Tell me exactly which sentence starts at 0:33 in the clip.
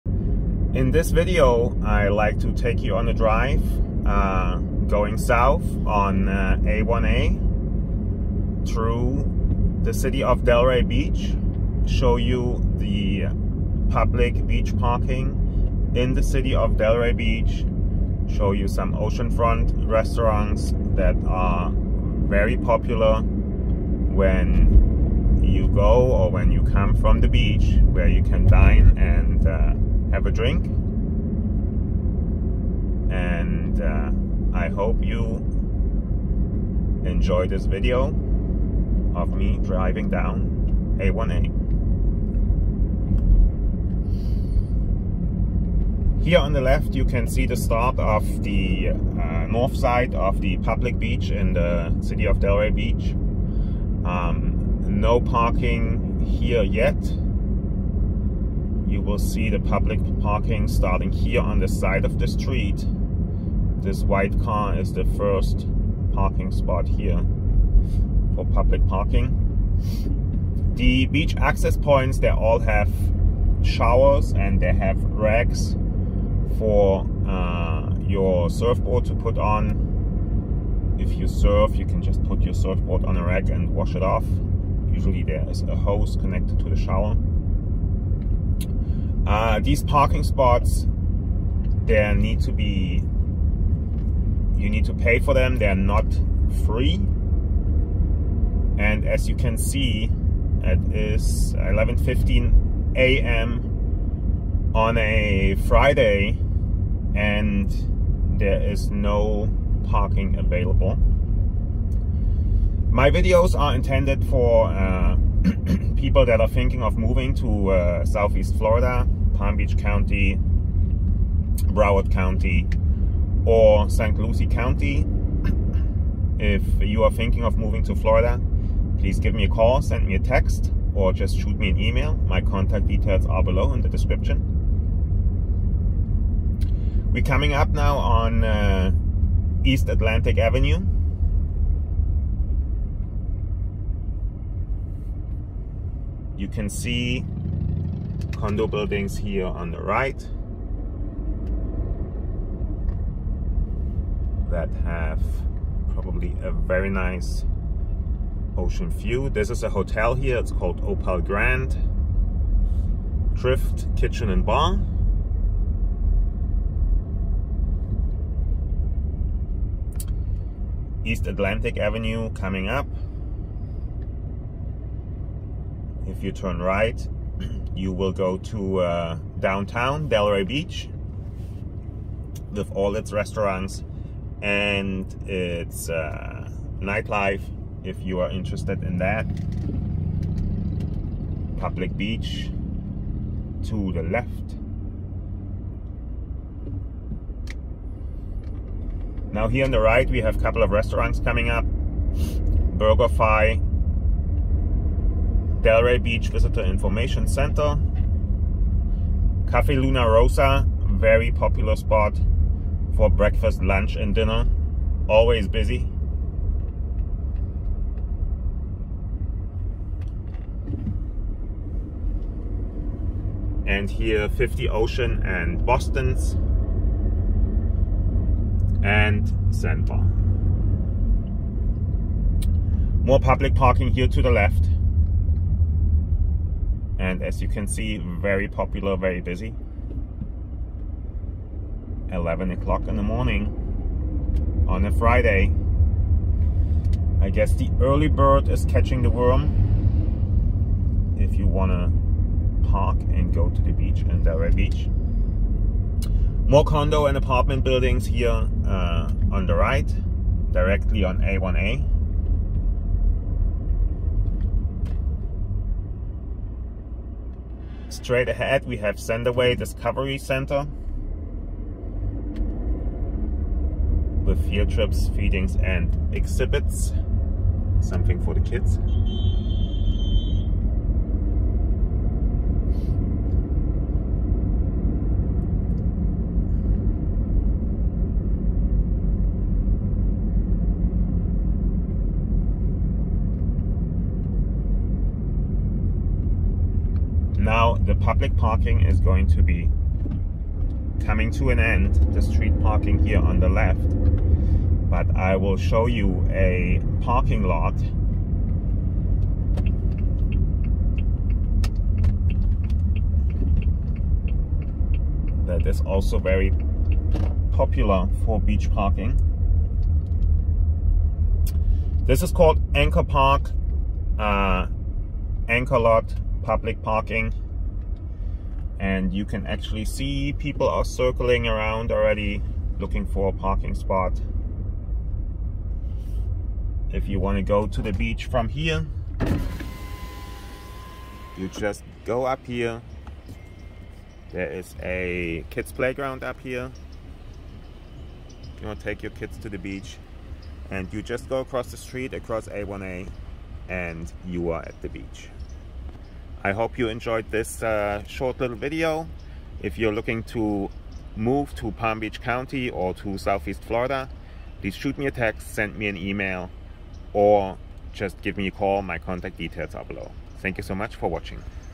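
And uh, I hope you enjoy this video of me driving down A1A.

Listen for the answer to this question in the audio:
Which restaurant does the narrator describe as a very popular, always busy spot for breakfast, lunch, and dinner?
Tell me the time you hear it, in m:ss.
3:29.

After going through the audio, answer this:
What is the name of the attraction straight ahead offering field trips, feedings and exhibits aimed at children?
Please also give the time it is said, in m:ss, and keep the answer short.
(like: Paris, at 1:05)
Sandoway Discovery Center, at 4:28.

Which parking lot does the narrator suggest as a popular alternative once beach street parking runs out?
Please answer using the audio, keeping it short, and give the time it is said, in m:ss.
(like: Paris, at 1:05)
Anchor Park, at 5:22.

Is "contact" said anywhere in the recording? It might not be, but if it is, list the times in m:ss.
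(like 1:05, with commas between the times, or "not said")
2:12, 6:08.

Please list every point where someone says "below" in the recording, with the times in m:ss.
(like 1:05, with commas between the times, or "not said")
2:13, 6:09.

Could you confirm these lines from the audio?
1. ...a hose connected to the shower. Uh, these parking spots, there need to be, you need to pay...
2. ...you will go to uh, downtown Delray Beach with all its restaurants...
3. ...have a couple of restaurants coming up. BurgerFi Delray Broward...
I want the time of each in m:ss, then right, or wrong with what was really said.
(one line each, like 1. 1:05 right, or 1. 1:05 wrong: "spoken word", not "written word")
1. 1:25 right
2. 2:57 right
3. 3:20 wrong: "Beach", not "Broward".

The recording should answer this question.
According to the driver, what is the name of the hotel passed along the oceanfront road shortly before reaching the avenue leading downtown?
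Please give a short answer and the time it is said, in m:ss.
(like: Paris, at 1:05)
Opal Grand, at 2:40.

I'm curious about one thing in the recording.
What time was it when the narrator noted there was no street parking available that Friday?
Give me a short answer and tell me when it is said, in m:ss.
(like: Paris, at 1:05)
11:15 a.m., at 1:41.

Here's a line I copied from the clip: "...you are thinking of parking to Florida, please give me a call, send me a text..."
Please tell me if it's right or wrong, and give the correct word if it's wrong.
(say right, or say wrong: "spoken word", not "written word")
wrong: "moving", not "parking".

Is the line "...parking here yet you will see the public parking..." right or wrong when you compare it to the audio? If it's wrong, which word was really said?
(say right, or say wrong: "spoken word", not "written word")
right.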